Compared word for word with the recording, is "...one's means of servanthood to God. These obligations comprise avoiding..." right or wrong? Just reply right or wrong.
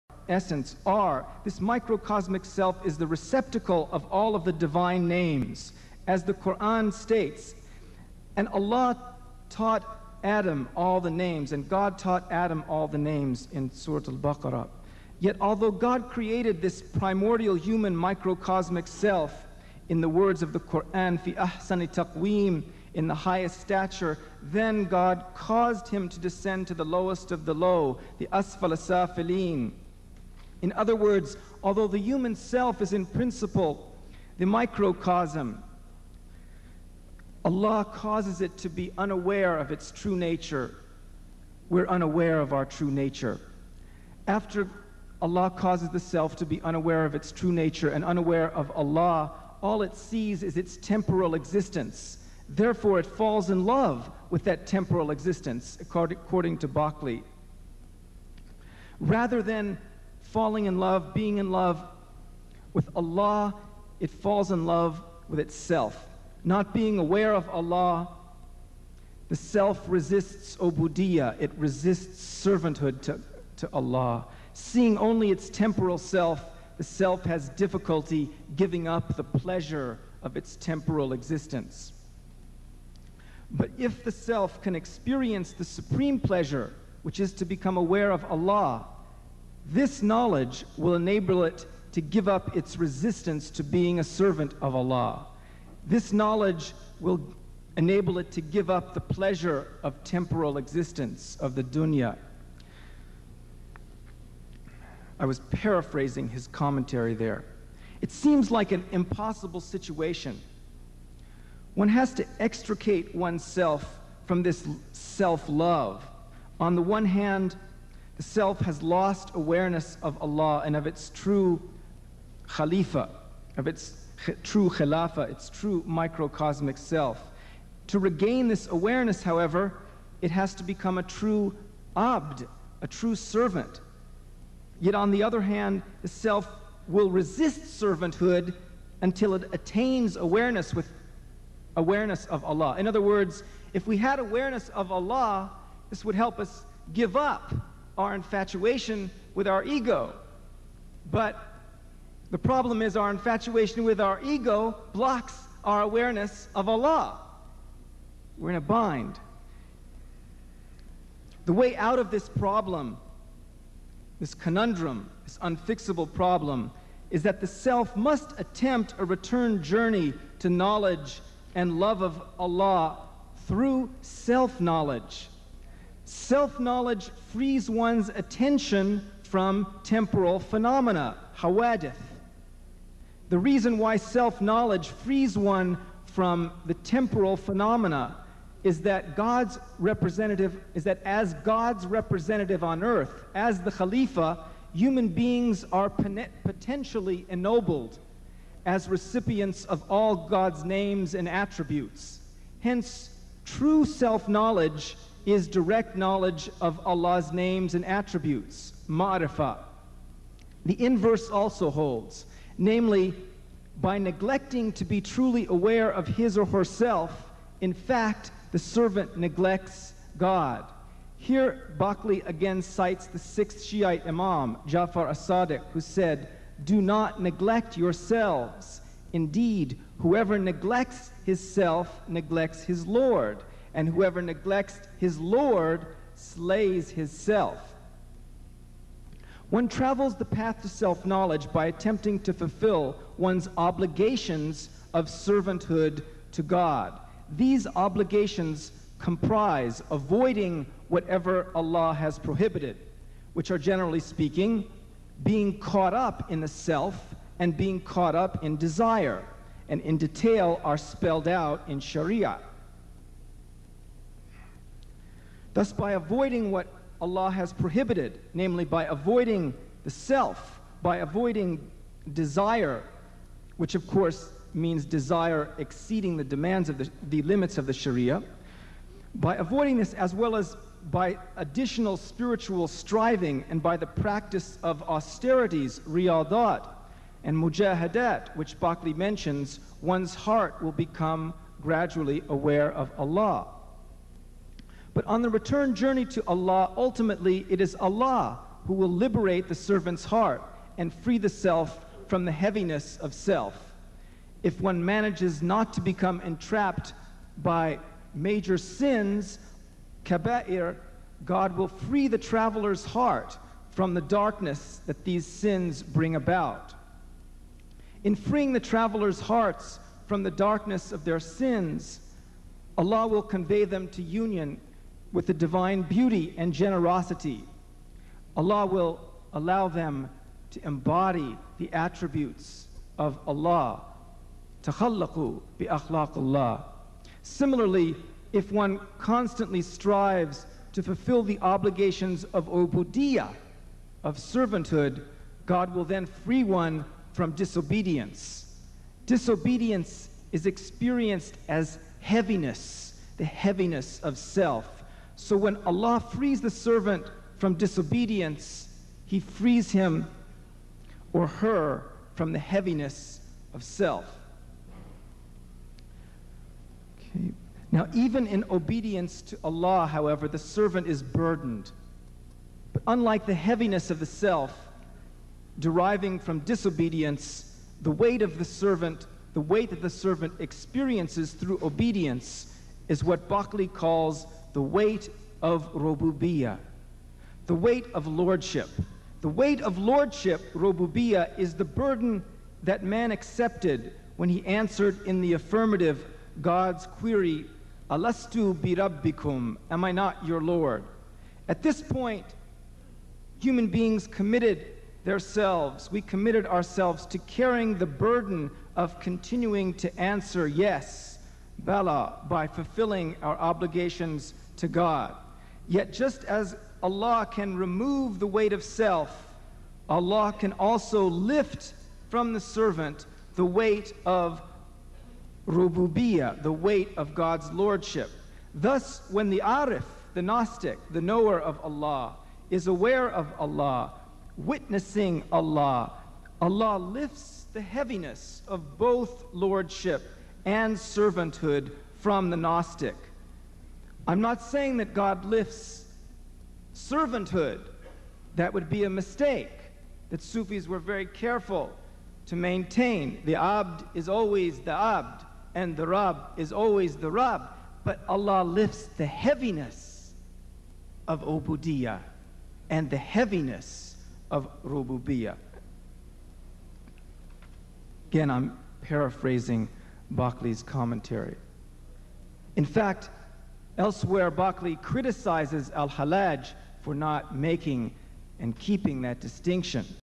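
wrong.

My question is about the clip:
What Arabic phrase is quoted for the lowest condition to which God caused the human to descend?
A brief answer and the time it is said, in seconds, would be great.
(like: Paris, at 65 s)
asfal asafilin, at 28 s.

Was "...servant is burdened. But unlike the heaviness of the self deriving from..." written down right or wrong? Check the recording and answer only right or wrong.
right.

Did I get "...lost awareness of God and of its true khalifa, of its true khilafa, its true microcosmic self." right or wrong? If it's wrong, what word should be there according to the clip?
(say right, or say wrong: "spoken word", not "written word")
wrong: "Allah", not "God".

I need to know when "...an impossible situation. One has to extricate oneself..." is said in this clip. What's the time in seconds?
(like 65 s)
108 s.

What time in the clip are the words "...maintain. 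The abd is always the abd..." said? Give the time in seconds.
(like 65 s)
452 s.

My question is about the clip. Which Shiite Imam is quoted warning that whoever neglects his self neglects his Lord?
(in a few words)
Jafar as-Sadiq.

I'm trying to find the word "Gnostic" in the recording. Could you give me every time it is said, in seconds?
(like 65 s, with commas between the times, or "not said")
430 s, 442 s.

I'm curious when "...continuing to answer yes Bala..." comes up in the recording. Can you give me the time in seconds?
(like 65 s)
408 s.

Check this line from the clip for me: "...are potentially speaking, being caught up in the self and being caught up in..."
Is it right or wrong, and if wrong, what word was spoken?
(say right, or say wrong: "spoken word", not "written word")
wrong: "generally", not "potentially".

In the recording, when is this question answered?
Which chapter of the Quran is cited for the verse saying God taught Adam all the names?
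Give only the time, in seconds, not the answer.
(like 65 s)
13 s.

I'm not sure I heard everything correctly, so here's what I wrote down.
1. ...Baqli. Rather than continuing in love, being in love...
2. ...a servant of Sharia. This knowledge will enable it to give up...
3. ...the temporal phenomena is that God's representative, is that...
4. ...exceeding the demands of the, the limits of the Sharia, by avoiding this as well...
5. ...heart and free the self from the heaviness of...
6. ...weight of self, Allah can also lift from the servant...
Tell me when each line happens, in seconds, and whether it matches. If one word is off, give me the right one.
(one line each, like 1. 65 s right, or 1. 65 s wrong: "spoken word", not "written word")
1. 56 s wrong: "falling", not "continuing"
2. 93 s wrong: "Allah", not "Sharia"
3. 186 s right
4. 275 s right
5. 300 s right
6. 418 s right.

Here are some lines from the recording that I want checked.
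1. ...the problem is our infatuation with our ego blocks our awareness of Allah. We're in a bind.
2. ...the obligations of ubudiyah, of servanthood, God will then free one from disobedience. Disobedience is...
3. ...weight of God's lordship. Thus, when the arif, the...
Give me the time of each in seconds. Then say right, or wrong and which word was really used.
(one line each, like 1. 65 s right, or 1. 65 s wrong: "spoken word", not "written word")
1. 152 s right
2. 341 s right
3. 426 s right.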